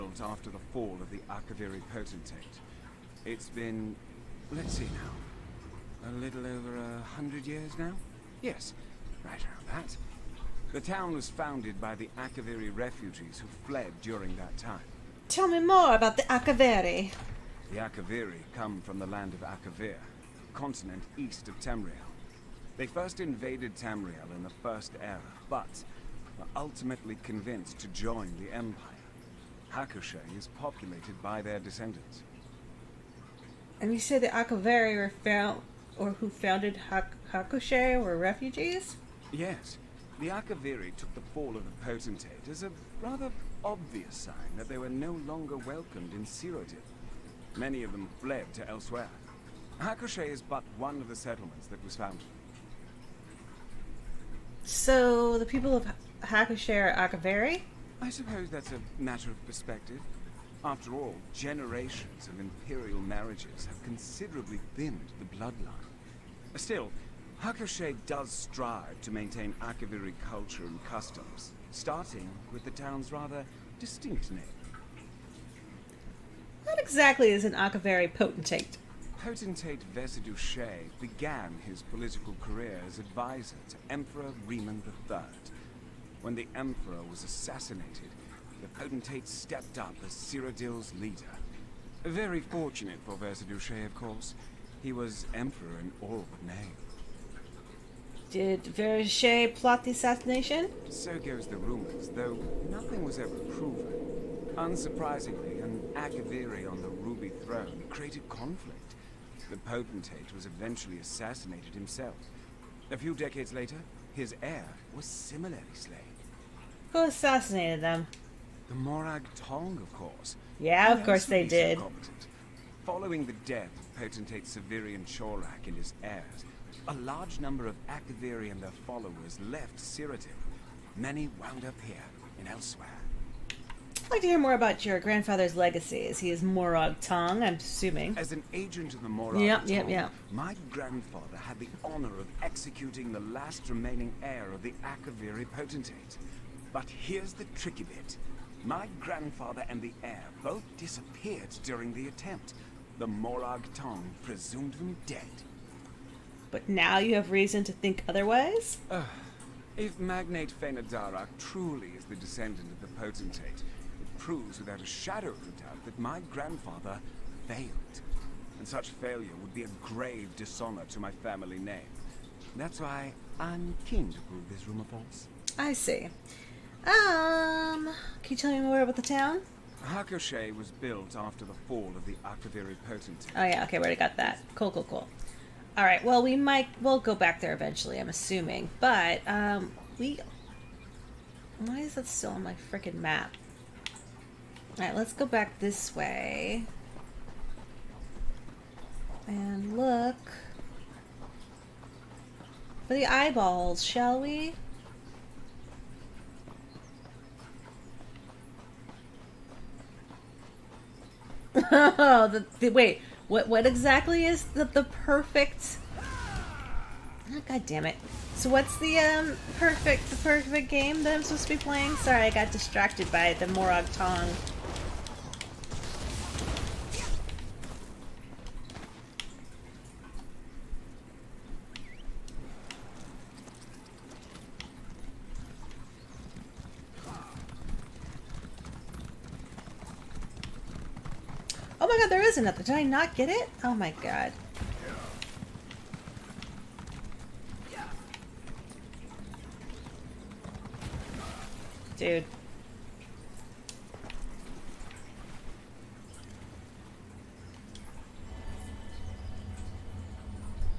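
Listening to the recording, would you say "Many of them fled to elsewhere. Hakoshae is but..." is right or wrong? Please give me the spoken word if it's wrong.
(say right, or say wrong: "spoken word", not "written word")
right.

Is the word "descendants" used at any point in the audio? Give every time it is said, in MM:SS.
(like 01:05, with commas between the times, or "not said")
00:31, 02:42.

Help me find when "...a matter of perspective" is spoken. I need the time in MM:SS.
00:58.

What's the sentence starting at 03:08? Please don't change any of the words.
But, um, we, why is that still on my freaking map?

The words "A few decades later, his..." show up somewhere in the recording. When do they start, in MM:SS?
01:52.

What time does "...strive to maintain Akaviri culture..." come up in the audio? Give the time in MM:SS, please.
01:08.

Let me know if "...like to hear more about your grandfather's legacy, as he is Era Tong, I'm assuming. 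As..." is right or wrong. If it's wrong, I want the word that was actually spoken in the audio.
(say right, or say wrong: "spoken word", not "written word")
wrong: "Morag", not "Era".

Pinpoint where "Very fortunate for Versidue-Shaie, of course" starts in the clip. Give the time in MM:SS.
01:32.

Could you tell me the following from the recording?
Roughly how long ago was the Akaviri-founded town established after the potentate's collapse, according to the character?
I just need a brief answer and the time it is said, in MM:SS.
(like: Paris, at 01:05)
A little over 100 years, at 00:06.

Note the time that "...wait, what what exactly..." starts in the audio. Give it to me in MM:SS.
03:32.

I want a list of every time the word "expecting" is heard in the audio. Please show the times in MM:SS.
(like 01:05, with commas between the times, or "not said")
not said.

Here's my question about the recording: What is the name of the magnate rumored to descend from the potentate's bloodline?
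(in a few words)
Fenadara.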